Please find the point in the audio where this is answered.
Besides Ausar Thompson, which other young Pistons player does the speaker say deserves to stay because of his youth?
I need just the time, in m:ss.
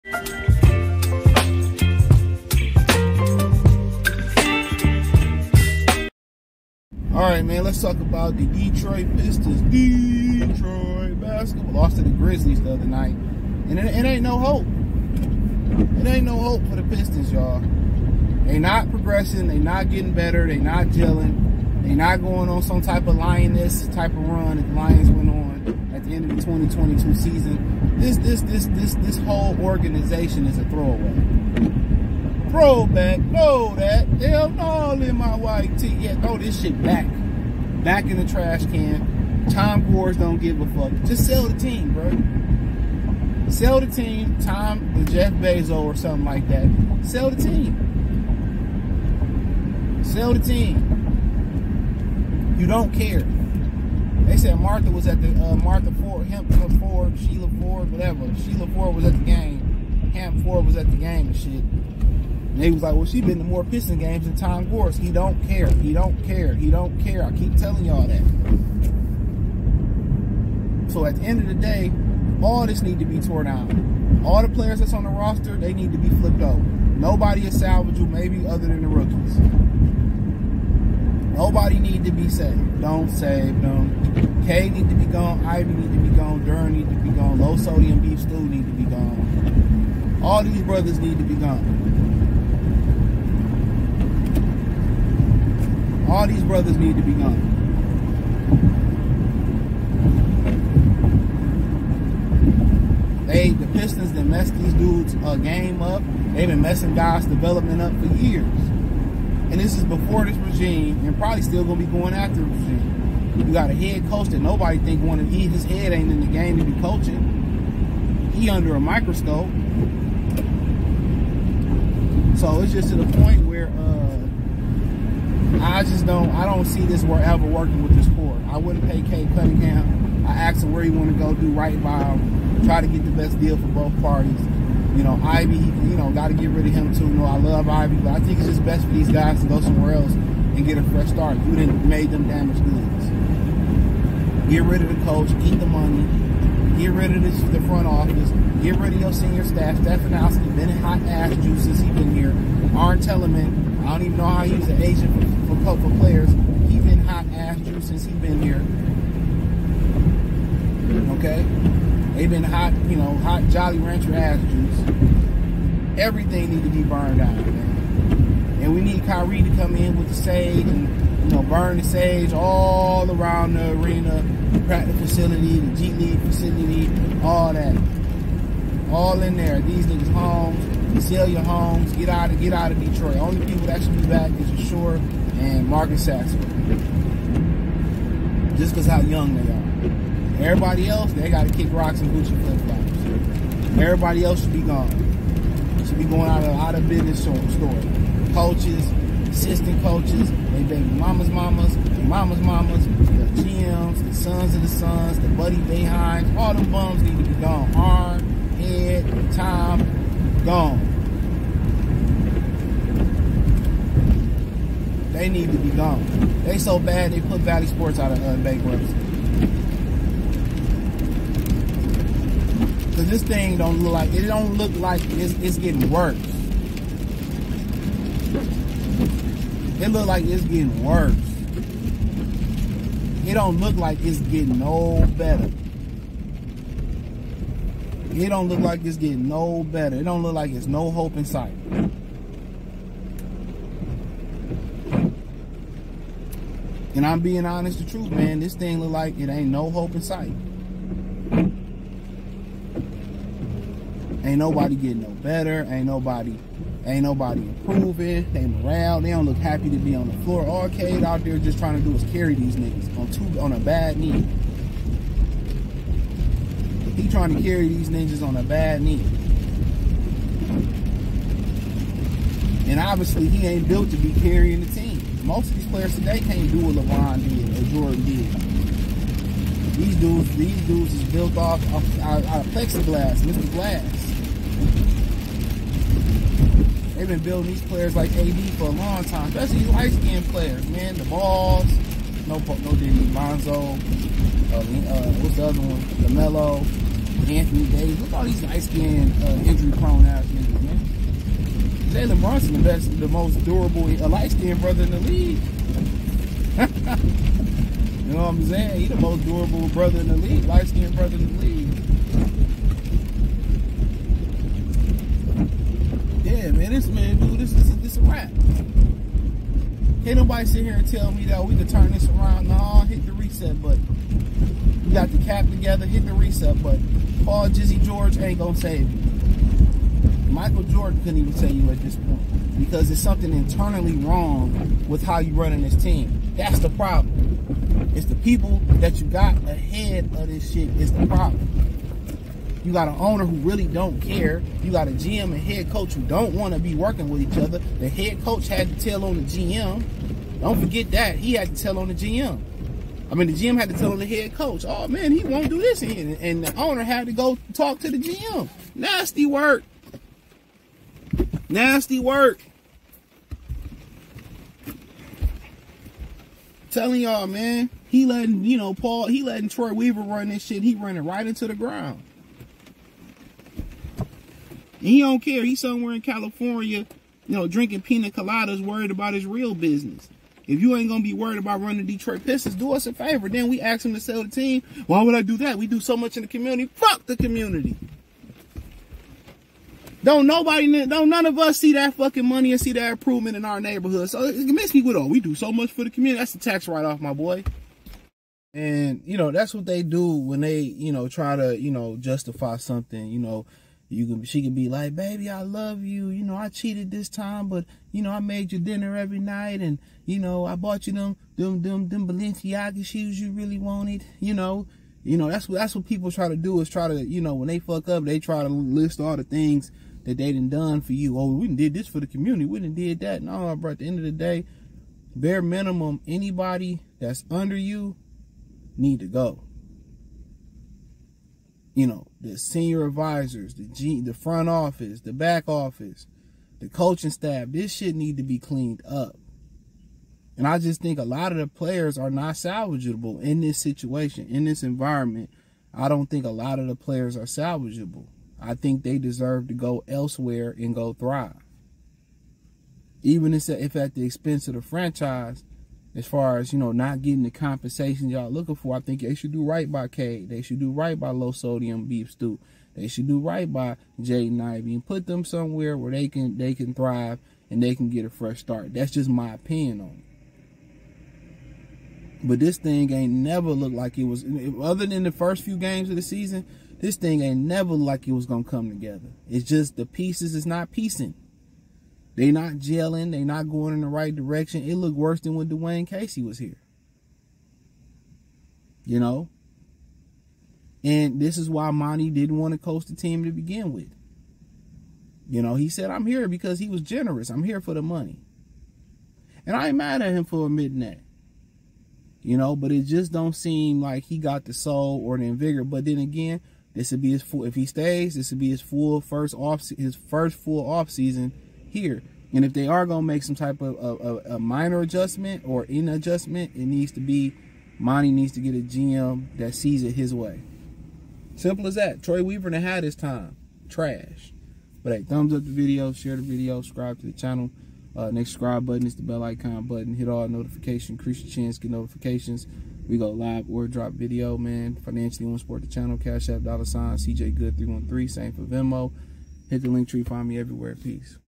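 3:05.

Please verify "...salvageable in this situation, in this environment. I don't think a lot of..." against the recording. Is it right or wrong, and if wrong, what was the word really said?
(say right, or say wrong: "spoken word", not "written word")
right.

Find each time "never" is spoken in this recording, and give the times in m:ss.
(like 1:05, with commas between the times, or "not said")
7:53, 7:57.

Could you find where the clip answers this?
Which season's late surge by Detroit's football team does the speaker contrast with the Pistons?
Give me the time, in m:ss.
0:26.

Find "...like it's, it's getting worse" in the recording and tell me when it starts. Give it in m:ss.
3:44.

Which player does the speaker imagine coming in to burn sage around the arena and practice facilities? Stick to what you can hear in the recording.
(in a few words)
Kyrie.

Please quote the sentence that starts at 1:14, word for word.
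All the players that's on the roster, they need to be flipped over.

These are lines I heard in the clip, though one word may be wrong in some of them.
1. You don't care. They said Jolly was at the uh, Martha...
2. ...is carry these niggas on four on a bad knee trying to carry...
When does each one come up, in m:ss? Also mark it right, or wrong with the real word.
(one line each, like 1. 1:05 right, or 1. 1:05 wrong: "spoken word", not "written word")
1. 0:52 wrong: "Martha", not "Jolly"
2. 4:21 wrong: "two", not "four".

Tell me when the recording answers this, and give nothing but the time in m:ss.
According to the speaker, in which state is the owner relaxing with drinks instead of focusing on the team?
6:16.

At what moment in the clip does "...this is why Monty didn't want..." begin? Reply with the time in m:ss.
8:11.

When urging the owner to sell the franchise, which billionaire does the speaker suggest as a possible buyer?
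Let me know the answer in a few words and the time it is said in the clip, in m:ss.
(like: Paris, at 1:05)
Jeff Bezos, at 0:45.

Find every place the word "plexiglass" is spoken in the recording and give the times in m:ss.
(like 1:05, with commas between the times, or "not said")
4:42.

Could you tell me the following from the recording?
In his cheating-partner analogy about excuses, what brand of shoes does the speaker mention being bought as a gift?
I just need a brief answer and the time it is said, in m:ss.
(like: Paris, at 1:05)
Balenciaga, at 6:52.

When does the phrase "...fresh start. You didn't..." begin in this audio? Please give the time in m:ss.
2:20.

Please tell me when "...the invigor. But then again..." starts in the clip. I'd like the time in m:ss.
8:25.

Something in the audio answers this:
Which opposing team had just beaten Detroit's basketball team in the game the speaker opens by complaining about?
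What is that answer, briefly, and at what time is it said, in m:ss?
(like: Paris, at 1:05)
Grizzlies, at 0:12.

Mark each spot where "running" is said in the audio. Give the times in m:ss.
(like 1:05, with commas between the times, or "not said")
5:35, 6:10, 6:21.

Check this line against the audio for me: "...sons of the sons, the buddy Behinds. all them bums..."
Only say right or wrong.
right.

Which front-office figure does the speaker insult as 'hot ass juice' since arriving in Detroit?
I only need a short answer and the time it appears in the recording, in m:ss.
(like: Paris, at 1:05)
Stefanowski, at 2:29.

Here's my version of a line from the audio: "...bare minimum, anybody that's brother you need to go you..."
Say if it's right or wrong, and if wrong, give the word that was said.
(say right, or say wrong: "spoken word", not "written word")
wrong: "under", not "brother".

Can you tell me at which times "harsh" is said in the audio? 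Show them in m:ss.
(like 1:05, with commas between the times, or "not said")
not said.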